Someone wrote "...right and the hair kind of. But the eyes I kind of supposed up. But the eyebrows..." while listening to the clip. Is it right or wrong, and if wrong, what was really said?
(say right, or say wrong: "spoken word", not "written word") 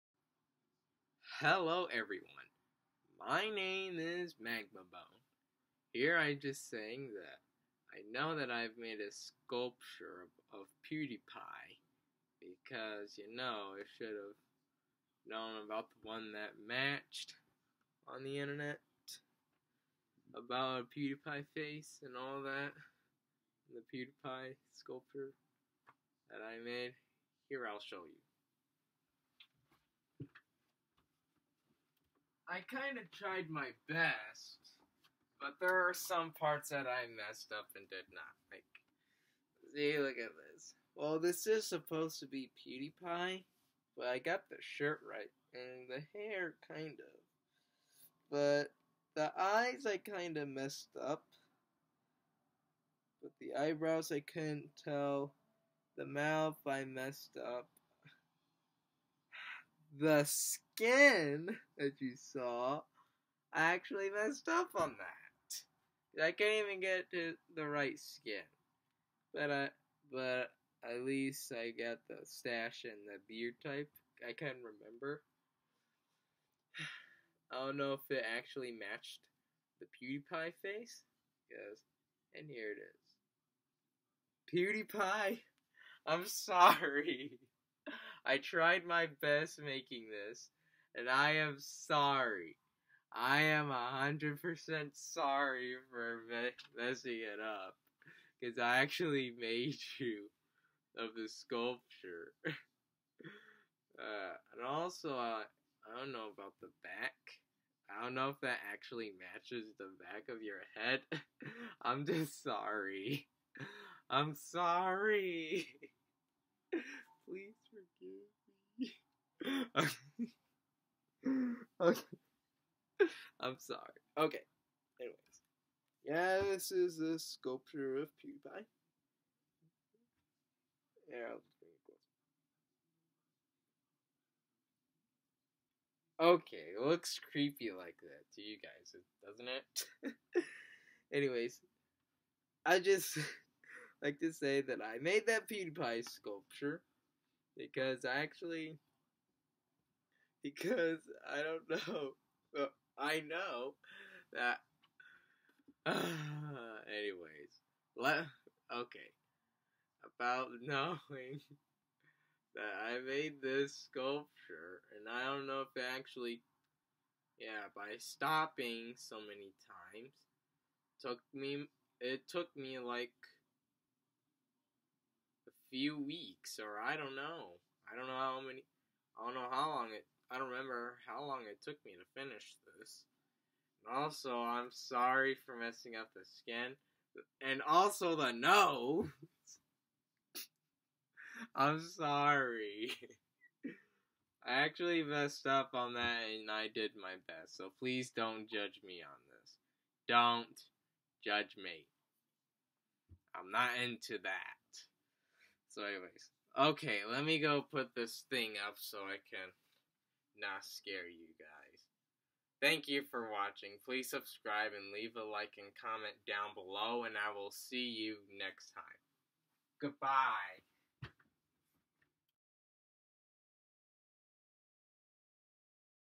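wrong: "messed", not "supposed".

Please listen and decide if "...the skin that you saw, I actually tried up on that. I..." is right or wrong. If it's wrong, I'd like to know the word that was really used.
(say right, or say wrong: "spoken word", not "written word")
wrong: "messed", not "tried".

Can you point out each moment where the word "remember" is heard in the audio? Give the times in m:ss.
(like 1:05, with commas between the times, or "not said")
1:14, 3:00.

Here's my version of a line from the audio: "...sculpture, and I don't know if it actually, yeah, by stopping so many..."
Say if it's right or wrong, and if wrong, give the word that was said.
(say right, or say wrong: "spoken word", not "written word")
right.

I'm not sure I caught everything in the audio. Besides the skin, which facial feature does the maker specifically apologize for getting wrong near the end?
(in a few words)
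the nose.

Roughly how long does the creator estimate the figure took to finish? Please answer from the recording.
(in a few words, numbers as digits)
a few weeks.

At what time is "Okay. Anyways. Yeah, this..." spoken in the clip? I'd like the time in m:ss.
2:04.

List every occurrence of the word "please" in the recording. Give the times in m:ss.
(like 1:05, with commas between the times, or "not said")
1:57, 3:17, 3:33.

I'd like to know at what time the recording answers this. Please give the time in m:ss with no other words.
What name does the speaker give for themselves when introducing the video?
0:04.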